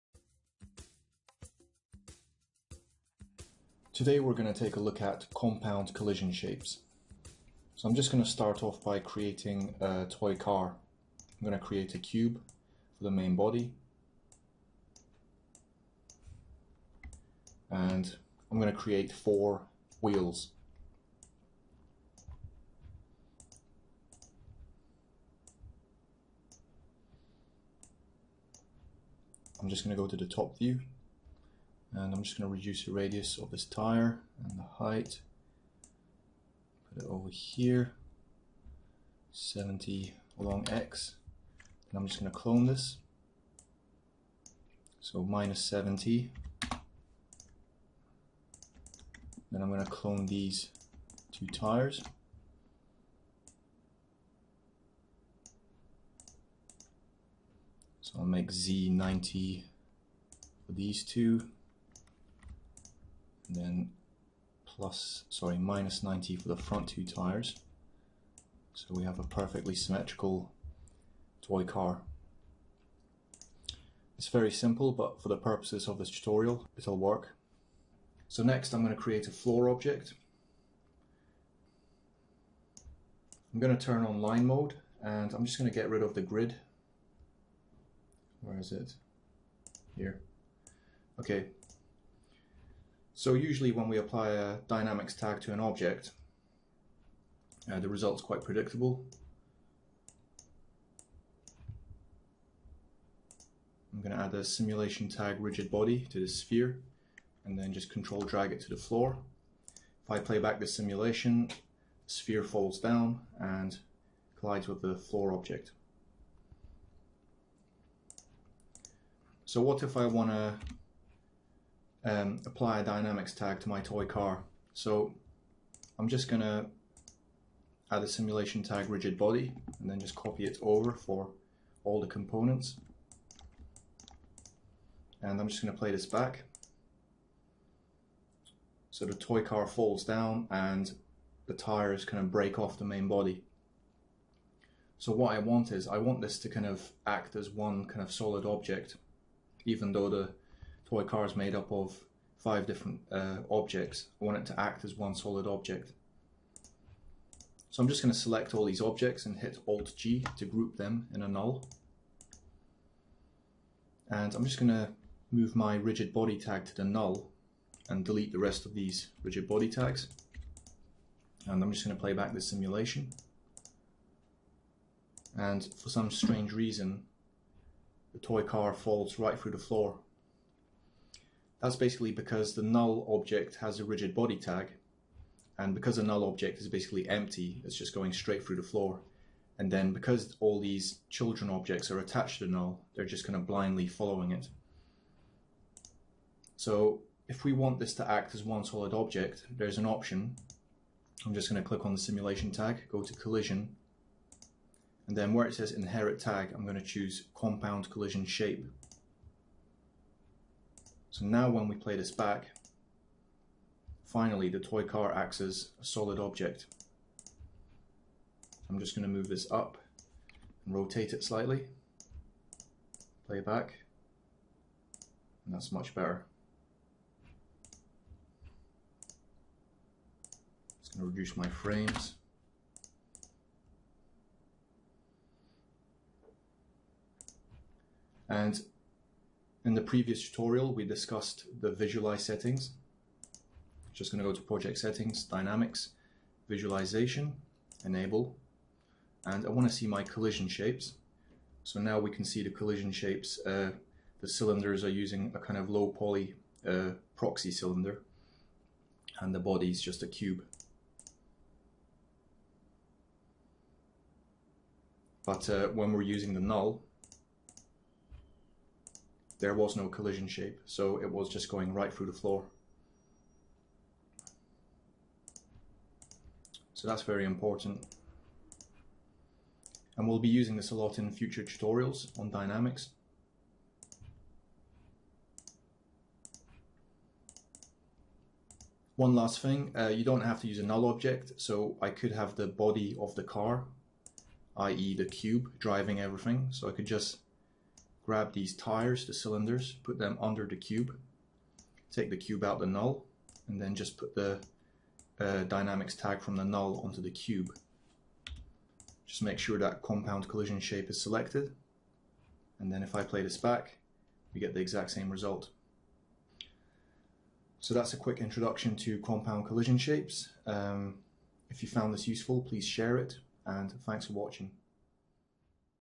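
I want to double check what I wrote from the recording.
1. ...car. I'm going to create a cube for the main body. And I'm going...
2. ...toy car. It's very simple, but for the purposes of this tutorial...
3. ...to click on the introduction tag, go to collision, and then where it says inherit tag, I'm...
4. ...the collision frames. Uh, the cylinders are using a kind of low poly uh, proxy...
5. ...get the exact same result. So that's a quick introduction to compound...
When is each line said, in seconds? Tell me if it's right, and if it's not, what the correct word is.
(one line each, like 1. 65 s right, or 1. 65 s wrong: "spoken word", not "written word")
1. 10 s right
2. 71 s right
3. 201 s wrong: "simulation", not "introduction"
4. 252 s wrong: "shapes", not "frames"
5. 314 s right.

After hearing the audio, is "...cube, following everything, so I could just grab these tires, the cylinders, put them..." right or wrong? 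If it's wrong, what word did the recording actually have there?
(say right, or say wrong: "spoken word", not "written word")
wrong: "driving", not "following".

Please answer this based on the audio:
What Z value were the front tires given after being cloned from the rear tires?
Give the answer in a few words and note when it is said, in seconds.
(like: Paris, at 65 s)
-90, at 65 s.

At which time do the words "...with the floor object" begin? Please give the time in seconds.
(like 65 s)
114 s.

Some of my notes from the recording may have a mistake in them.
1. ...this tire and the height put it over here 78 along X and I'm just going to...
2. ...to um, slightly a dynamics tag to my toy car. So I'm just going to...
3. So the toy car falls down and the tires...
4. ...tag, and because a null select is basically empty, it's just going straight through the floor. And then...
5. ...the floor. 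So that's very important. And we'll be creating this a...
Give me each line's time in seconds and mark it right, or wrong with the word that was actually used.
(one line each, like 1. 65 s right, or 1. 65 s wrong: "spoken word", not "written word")
1. 33 s wrong: "70", not "78"
2. 120 s wrong: "apply", not "slightly"
3. 138 s right
4. 184 s wrong: "object", not "select"
5. 272 s wrong: "using", not "creating".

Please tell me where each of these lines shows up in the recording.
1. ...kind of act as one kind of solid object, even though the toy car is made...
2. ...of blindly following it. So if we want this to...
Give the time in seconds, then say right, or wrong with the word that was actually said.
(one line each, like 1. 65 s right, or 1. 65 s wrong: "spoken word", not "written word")
1. 146 s right
2. 193 s right.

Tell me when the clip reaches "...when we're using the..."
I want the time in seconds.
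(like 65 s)
265 s.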